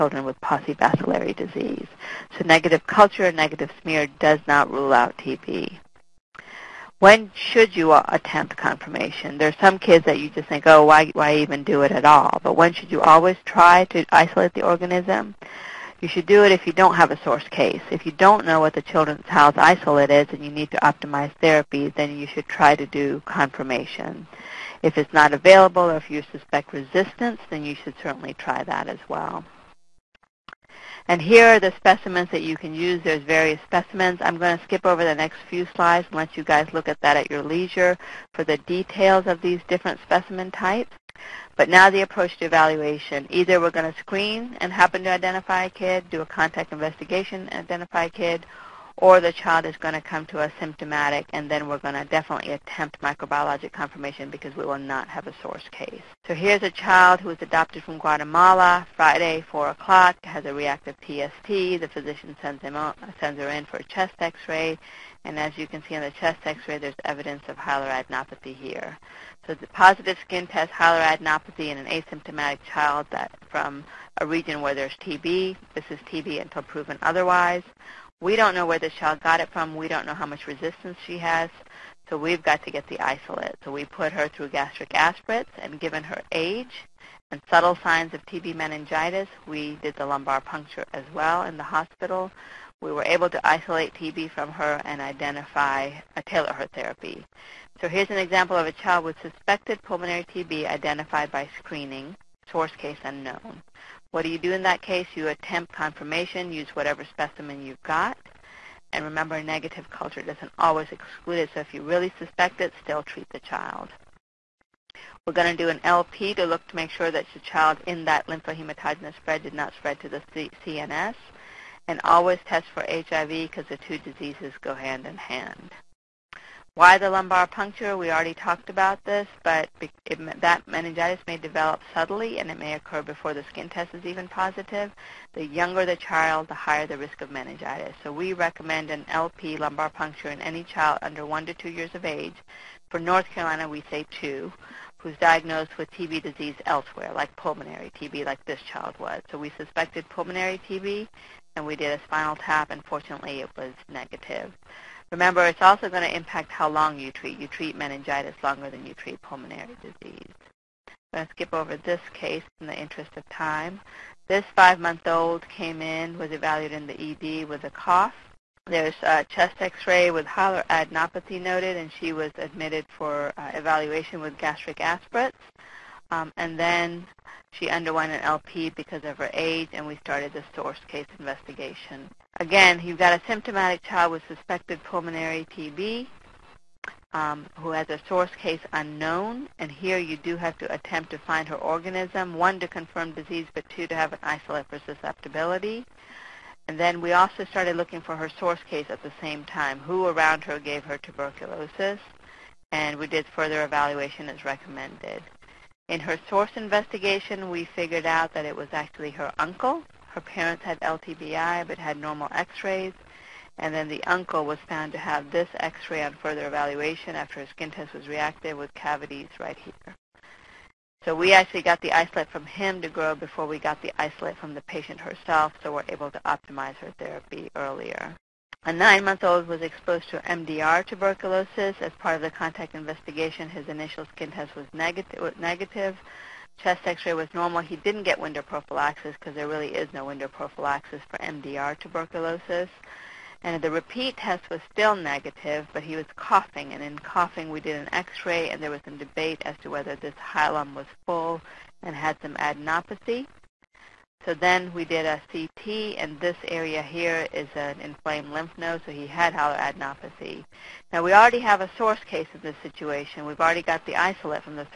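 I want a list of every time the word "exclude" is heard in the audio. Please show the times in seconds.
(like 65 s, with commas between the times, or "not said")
110 s.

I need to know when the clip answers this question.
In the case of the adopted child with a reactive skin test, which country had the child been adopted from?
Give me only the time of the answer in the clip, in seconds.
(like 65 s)
57 s.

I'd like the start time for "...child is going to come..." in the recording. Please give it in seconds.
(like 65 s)
49 s.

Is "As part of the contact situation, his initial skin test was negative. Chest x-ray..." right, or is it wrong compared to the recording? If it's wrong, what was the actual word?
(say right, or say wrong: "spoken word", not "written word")
wrong: "investigation", not "situation".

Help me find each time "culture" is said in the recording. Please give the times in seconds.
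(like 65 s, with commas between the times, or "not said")
2 s, 109 s.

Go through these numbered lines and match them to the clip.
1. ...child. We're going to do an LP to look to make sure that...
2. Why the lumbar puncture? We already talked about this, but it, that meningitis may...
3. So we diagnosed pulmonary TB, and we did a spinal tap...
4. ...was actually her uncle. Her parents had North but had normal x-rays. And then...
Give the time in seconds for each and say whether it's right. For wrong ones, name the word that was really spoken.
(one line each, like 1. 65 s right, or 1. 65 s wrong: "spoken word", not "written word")
1. 113 s right
2. 126 s right
3. 149 s wrong: "suspected", not "diagnosed"
4. 208 s wrong: "LTBI", not "North".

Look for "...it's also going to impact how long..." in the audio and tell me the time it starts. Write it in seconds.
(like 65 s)
155 s.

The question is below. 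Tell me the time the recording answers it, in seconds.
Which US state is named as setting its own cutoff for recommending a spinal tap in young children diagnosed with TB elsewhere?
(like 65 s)
142 s.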